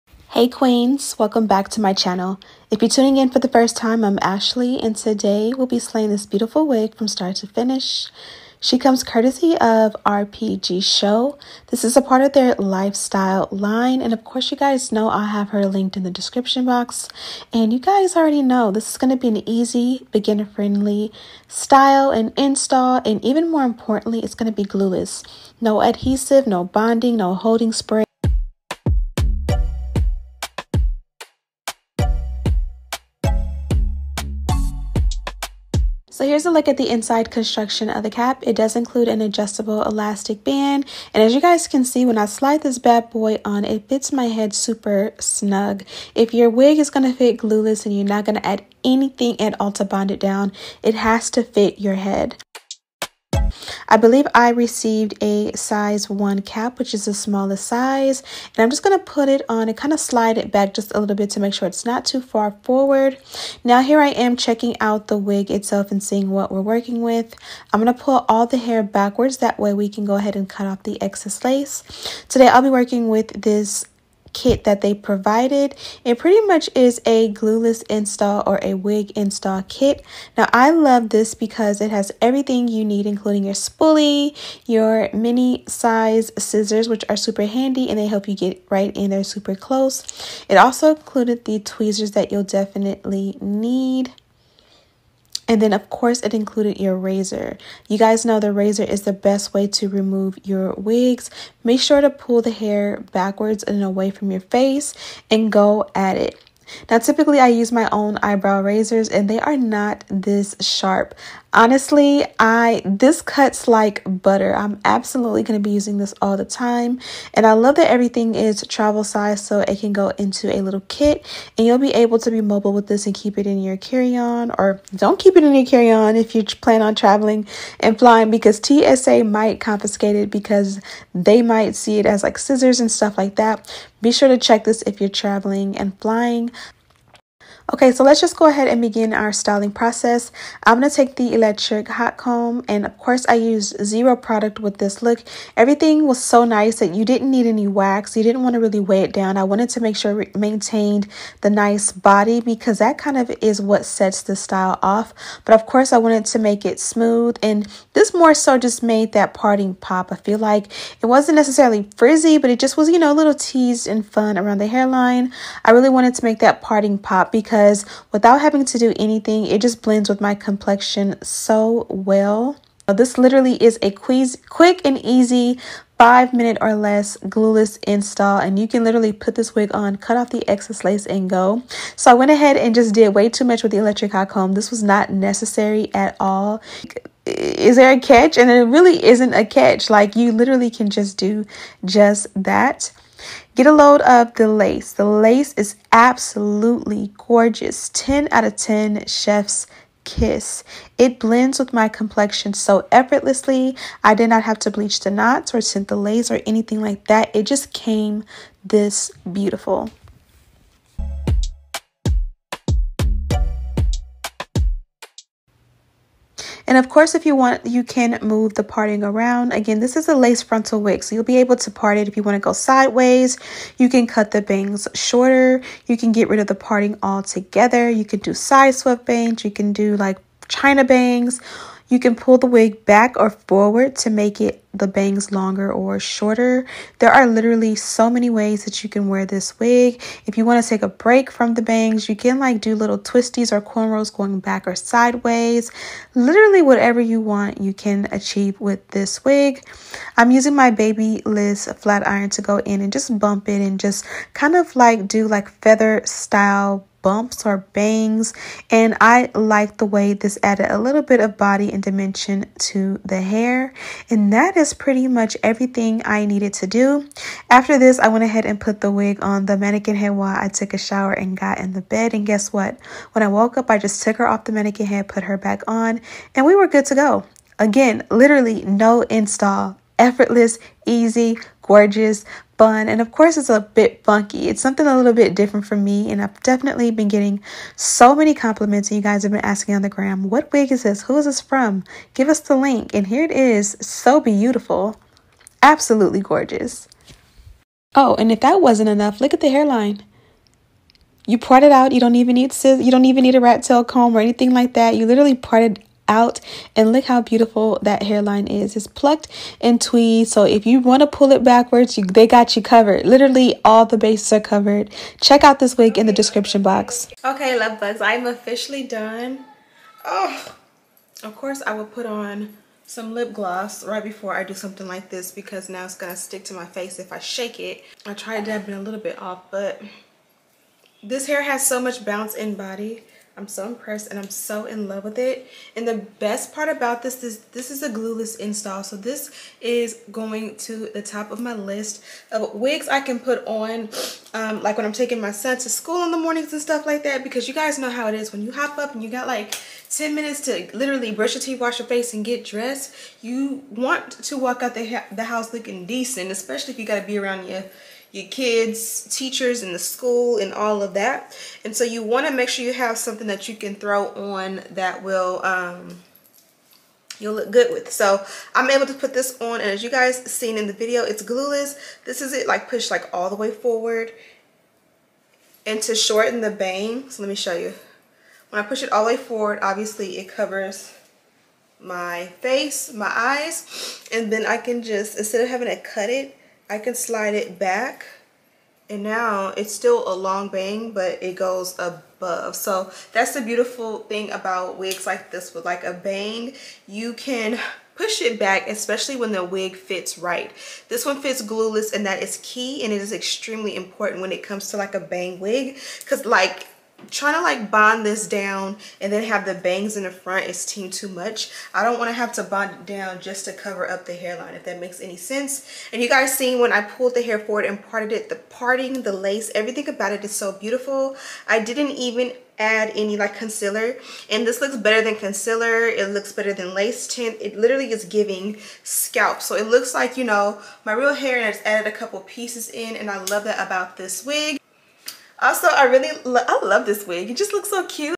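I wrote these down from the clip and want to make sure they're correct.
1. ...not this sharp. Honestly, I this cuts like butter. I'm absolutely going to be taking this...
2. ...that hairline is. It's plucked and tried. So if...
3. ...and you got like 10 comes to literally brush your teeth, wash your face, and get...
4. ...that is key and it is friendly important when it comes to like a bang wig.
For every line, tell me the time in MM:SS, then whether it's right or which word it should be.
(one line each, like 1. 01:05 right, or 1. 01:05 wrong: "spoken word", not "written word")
1. 01:49 wrong: "using", not "taking"
2. 05:07 wrong: "tweed", not "tried"
3. 05:48 wrong: "minutes", not "comes"
4. 06:42 wrong: "extremely", not "friendly".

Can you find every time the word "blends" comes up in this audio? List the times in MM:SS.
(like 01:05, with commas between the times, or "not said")
02:49, 03:21.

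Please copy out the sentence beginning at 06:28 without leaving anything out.
And now it's still a long bang, but it goes above.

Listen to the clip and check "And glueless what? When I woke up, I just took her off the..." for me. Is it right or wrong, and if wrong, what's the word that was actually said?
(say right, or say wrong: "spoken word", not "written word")
wrong: "guess", not "glueless".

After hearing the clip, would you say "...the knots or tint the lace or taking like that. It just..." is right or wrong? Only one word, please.
wrong.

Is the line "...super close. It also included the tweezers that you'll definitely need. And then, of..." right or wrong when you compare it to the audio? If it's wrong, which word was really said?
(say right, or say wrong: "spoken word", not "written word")
right.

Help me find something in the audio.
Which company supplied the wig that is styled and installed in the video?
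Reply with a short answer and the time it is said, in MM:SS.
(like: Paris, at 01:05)
RPG Show, at 00:10.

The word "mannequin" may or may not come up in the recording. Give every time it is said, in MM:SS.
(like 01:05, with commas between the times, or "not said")
04:29, 04:34.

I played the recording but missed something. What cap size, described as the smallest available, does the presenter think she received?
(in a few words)
1.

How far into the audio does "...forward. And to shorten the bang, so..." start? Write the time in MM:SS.
06:13.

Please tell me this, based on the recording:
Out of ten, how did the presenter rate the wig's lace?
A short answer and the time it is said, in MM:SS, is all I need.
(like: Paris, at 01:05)
10, at 03:17.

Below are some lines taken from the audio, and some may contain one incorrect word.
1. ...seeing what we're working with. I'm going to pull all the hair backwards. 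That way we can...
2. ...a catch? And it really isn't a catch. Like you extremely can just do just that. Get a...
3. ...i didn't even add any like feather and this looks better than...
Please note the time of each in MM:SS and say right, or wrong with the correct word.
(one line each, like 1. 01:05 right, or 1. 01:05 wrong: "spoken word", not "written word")
1. 01:06 right
2. 03:07 wrong: "literally", not "extremely"
3. 07:01 wrong: "concealer", not "feather".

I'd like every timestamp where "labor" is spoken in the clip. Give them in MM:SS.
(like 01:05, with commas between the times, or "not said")
not said.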